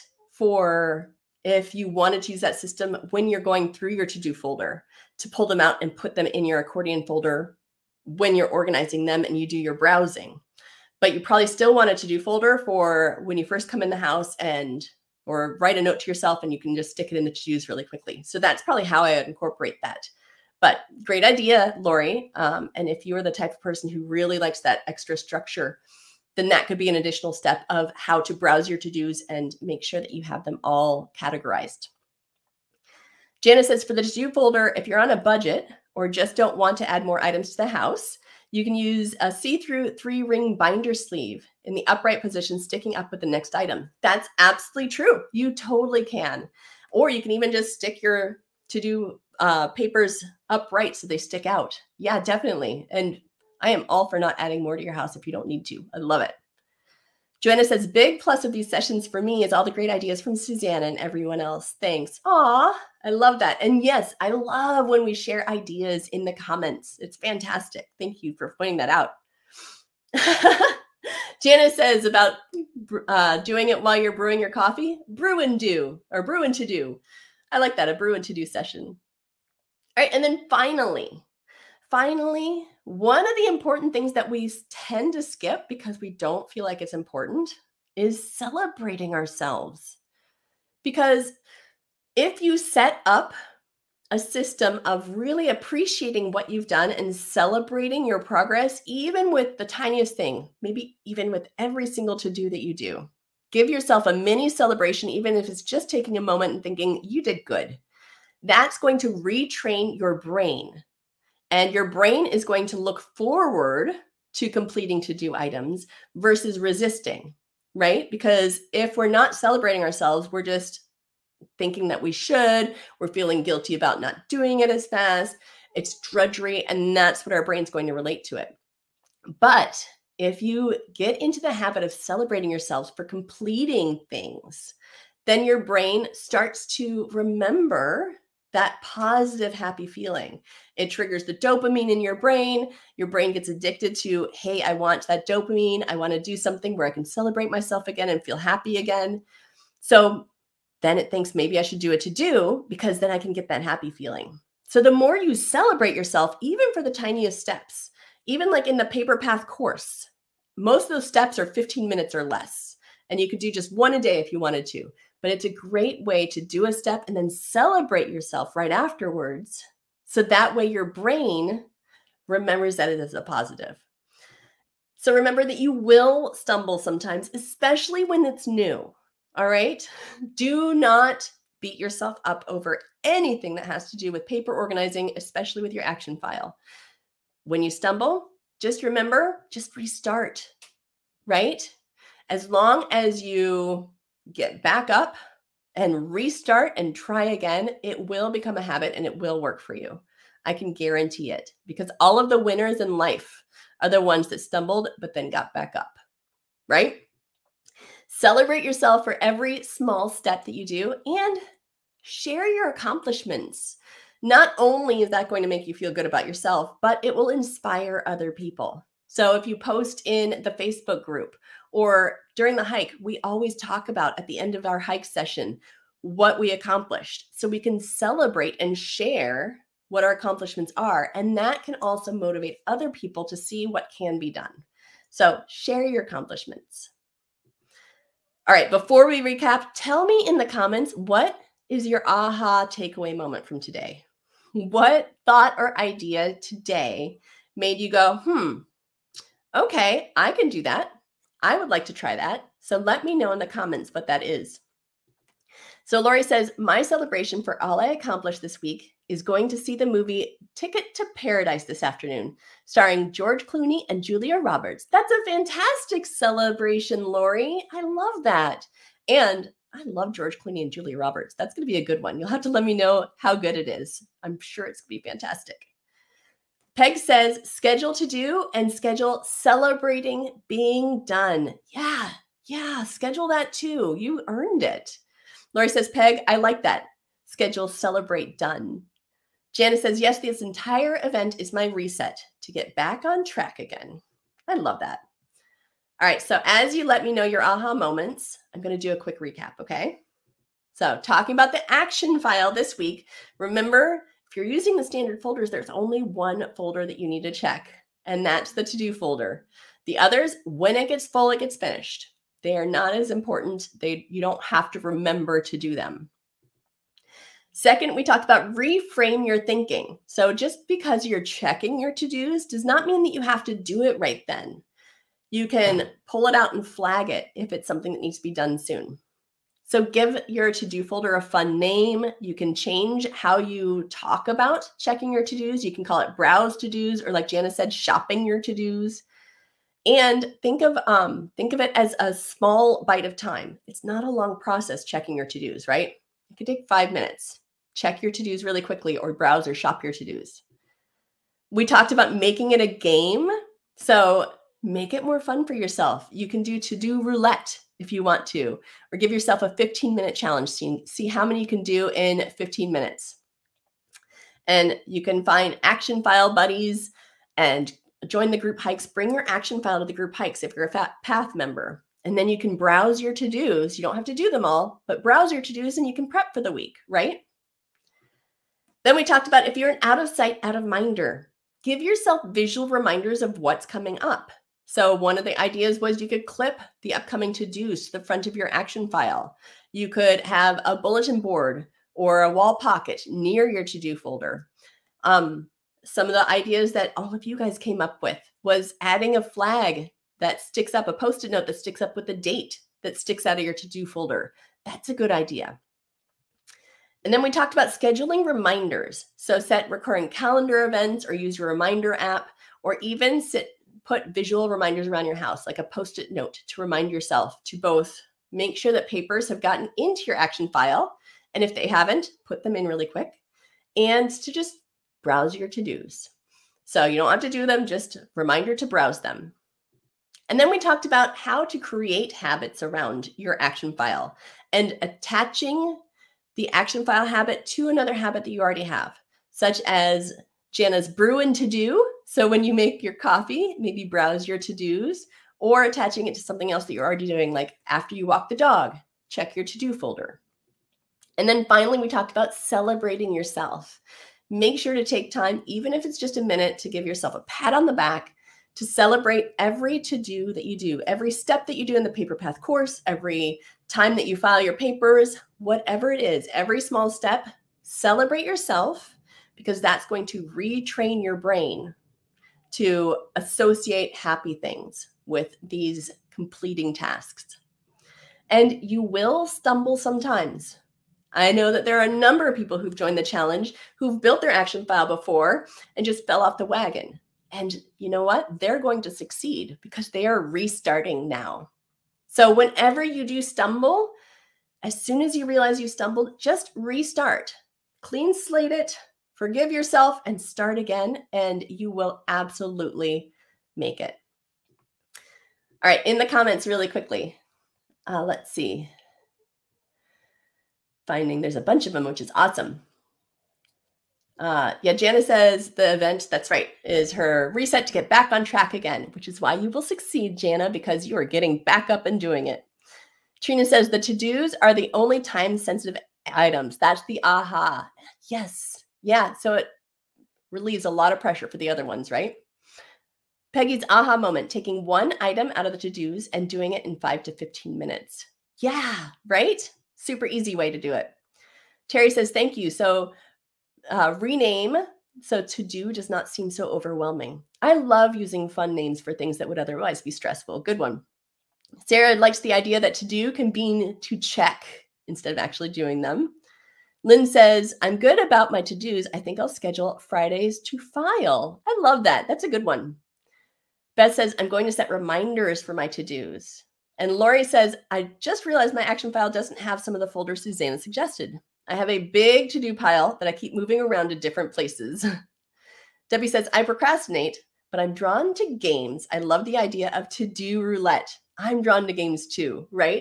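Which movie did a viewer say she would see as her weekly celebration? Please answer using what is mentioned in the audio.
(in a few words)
Ticket to Paradise.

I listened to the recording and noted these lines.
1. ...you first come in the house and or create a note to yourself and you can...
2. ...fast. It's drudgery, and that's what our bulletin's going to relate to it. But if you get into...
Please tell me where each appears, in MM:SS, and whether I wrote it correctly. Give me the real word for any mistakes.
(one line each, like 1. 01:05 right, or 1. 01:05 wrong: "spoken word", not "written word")
1. 00:13 wrong: "write", not "create"
2. 02:04 wrong: "brain", not "bulletin".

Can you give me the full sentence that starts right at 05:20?
So just because you're checking your to-dos does not mean that you have to do it right then.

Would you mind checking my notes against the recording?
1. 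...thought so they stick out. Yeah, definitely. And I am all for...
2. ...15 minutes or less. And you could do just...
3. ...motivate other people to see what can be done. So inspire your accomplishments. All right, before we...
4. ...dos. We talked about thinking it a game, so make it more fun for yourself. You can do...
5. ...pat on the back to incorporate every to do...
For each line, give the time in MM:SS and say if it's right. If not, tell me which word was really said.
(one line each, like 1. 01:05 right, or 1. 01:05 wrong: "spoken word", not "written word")
1. 00:50 wrong: "upright", not "thought"
2. 02:41 right
3. 03:52 wrong: "share", not "inspire"
4. 05:50 wrong: "making", not "thinking"
5. 07:37 wrong: "celebrate", not "incorporate".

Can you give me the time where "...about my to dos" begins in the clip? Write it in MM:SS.
09:18.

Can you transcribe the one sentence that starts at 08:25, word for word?
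All right, in the comments, really quickly.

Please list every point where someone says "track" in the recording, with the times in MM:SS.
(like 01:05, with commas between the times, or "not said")
04:53, 08:38.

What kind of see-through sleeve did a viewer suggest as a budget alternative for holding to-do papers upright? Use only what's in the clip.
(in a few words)
Three ring binder sleeve.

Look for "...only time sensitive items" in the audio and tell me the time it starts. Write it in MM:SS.
08:44.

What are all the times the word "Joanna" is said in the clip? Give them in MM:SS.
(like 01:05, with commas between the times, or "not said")
00:57.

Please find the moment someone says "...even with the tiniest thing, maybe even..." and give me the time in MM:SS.
01:38.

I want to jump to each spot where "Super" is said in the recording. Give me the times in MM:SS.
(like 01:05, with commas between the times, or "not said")
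08:59.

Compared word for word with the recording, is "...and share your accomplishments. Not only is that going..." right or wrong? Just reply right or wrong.
right.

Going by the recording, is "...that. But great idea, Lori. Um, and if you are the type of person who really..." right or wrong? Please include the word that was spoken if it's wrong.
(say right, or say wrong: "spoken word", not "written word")
right.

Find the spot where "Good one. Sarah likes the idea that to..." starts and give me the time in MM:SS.
09:10.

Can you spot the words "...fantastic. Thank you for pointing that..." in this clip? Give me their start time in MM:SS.
01:07.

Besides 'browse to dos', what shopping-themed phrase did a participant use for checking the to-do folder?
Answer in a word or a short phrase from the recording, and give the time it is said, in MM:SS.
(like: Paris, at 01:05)
Shopping your to dos, at 05:37.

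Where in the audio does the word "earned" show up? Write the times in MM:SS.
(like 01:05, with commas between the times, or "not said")
04:44.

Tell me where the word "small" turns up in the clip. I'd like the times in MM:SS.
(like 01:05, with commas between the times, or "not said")
03:29, 05:42, 07:46.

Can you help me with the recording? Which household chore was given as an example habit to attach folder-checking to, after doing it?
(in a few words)
Walk the dog.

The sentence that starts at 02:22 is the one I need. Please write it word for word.
Your brain gets addicted to, hey, I want that dopamine.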